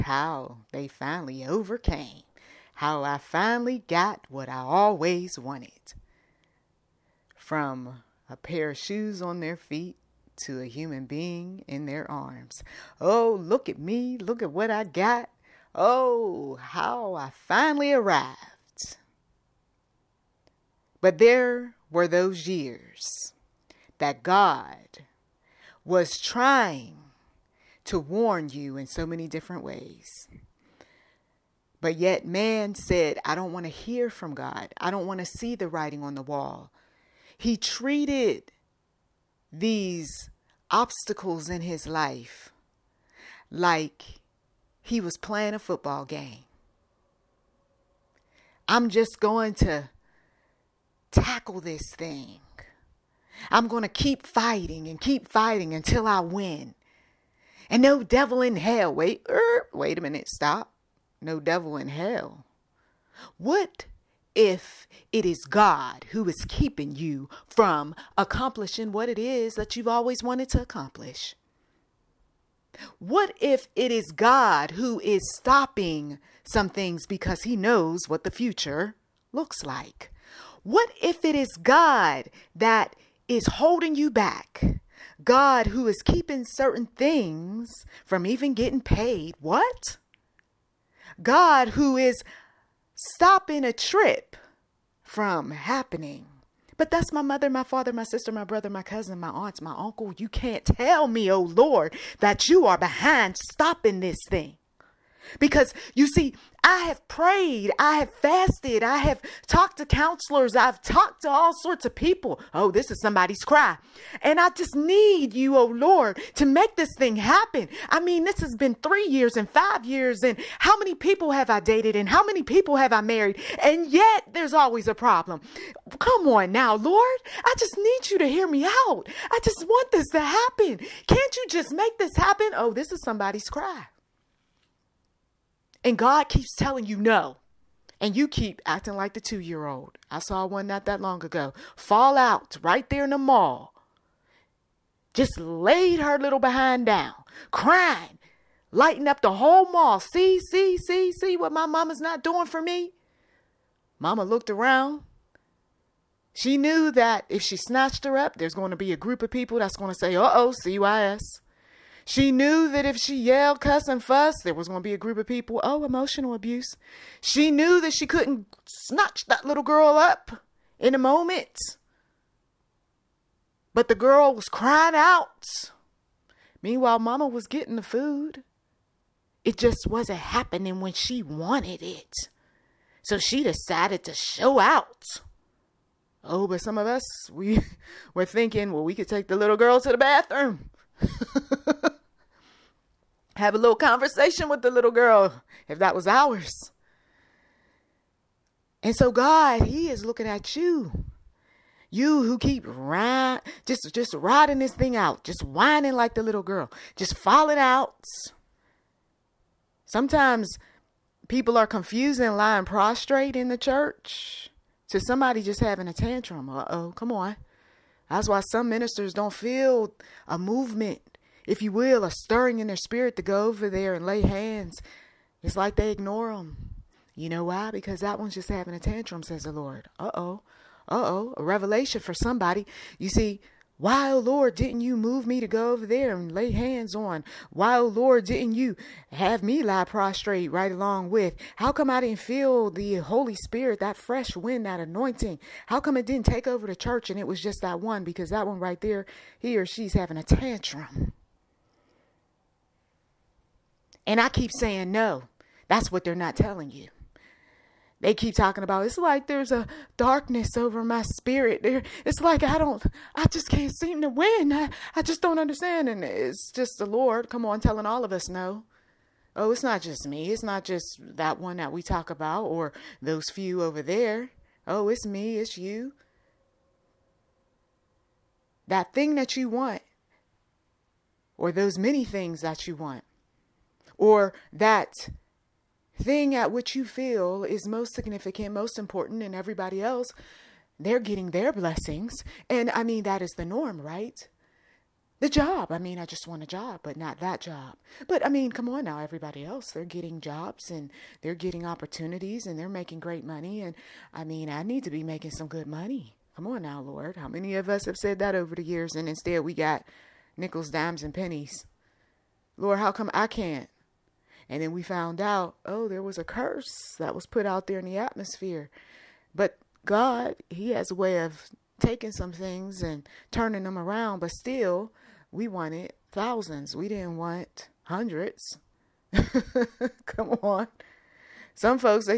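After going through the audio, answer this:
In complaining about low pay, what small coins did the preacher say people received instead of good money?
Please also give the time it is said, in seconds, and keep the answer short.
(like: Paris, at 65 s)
Nickels, dimes, and pennies, at 310 s.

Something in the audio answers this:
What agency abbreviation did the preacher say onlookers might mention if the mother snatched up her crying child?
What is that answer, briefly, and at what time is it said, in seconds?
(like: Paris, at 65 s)
CYS, at 160 s.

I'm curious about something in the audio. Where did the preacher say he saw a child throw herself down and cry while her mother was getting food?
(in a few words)
The mall.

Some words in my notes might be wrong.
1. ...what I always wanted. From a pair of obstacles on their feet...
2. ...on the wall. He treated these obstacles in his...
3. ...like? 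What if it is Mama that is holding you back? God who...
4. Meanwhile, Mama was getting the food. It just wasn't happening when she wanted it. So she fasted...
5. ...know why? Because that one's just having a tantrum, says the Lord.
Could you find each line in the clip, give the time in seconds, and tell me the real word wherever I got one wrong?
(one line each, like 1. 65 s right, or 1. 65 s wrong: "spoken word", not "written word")
1. 4 s wrong: "shoes", not "obstacles"
2. 36 s right
3. 79 s wrong: "God", not "Mama"
4. 176 s wrong: "decided", not "fasted"
5. 227 s right.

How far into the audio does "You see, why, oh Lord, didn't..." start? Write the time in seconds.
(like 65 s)
232 s.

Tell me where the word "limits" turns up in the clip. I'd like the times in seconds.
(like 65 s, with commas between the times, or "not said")
not said.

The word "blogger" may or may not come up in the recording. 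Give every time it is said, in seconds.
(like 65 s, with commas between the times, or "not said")
not said.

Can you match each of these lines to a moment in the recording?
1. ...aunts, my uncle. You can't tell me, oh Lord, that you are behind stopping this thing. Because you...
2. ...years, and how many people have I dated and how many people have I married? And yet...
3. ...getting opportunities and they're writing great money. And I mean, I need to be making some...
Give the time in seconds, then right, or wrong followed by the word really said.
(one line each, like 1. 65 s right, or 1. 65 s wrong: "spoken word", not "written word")
1. 99 s right
2. 119 s right
3. 301 s wrong: "making", not "writing".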